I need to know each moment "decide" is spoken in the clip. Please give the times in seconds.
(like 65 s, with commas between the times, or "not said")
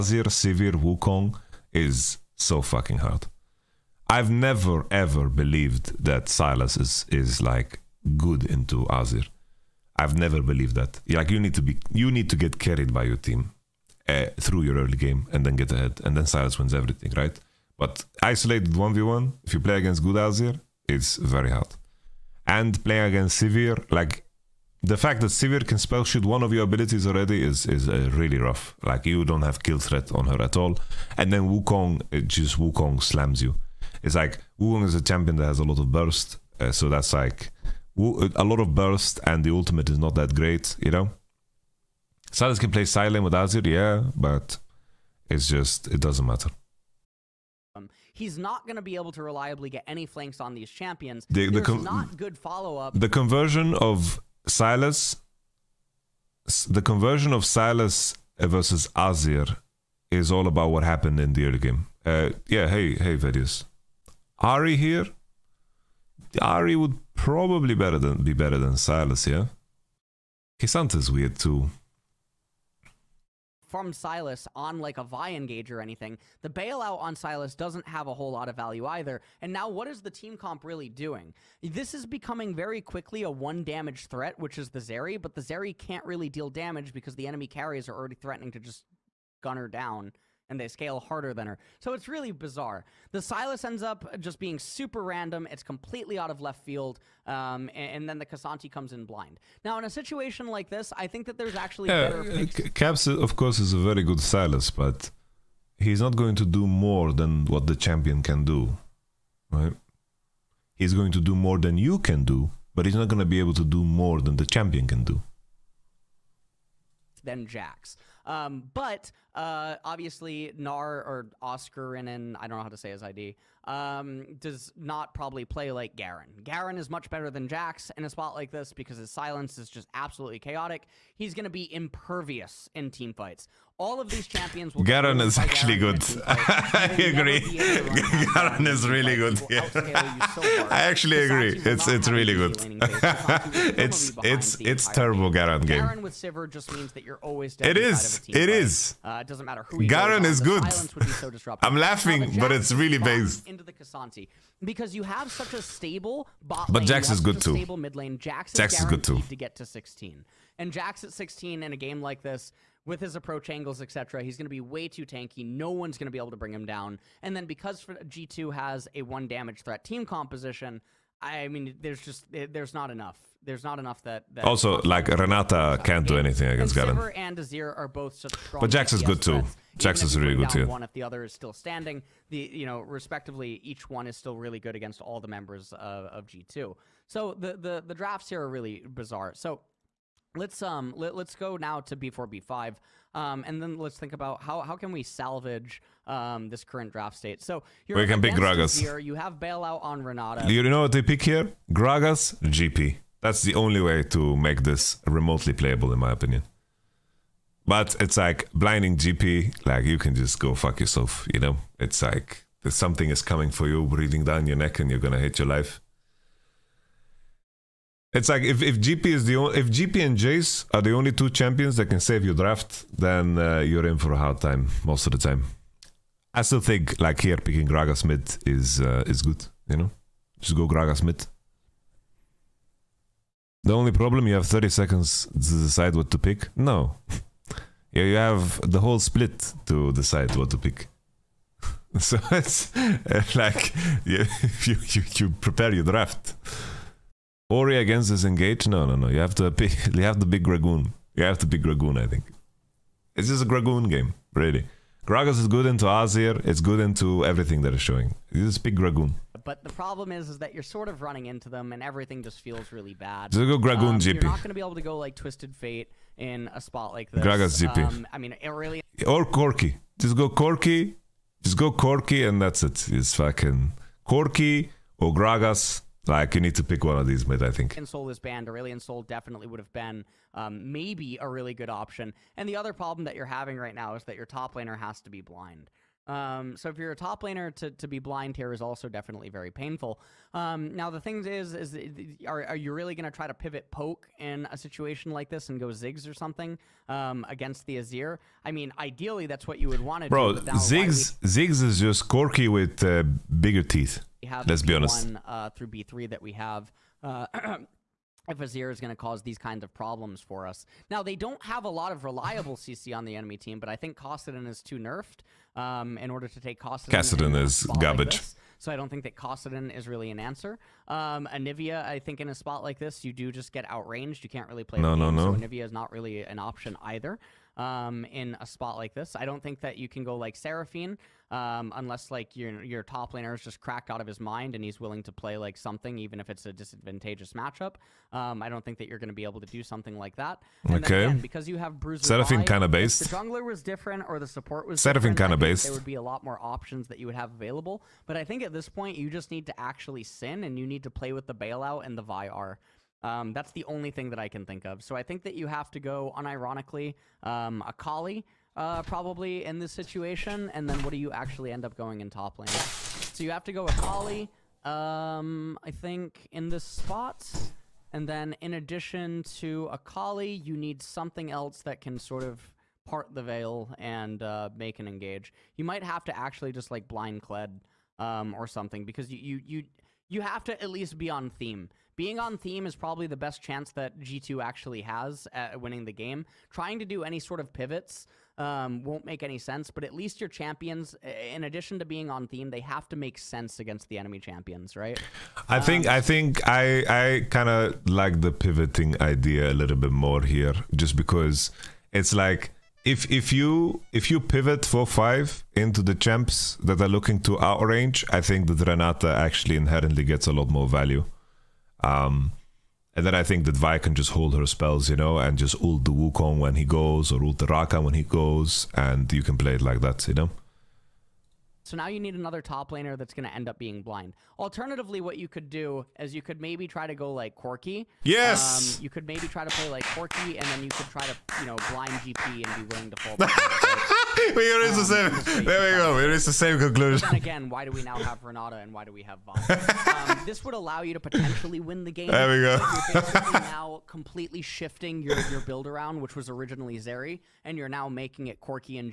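235 s, 239 s.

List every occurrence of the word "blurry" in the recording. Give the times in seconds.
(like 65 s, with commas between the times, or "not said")
not said.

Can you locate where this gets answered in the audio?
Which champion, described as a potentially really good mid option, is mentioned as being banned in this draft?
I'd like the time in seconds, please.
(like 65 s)
278 s.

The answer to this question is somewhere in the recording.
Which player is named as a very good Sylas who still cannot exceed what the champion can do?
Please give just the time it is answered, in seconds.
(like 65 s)
102 s.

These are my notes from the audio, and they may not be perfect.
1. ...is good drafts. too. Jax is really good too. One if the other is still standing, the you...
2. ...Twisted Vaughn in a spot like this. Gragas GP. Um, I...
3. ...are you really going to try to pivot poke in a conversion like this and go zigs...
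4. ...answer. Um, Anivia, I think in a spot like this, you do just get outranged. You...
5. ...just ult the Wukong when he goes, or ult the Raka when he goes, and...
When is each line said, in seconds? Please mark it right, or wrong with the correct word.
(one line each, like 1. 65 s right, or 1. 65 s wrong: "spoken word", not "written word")
1. 178 s wrong: "threats", not "drafts"
2. 265 s wrong: "Fate", not "Vaughn"
3. 292 s wrong: "situation", not "conversion"
4. 320 s right
5. 415 s right.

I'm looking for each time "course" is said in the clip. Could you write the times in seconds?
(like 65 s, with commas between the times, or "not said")
103 s.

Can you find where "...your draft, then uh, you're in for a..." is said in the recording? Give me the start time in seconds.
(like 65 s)
222 s.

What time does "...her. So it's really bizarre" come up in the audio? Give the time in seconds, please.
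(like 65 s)
91 s.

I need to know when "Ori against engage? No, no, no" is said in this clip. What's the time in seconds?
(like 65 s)
247 s.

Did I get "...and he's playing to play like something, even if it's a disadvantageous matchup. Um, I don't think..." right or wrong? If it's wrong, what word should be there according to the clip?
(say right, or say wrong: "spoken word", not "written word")
wrong: "willing", not "playing".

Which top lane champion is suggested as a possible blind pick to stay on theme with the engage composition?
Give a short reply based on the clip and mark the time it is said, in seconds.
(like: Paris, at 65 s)
Kled, at 377 s.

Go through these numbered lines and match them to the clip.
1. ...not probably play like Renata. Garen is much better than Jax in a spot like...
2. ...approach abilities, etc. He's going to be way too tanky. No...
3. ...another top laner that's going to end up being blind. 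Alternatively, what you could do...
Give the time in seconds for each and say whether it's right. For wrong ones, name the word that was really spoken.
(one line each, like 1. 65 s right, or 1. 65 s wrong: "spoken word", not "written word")
1. 124 s wrong: "Garen", not "Renata"
2. 163 s wrong: "angles", not "abilities"
3. 422 s right.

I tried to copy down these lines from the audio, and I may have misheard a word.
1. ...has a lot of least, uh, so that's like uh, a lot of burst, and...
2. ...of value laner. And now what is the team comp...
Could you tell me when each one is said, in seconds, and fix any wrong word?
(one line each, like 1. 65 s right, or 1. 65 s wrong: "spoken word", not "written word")
1. 35 s wrong: "burst", not "least"
2. 78 s wrong: "either", not "laner".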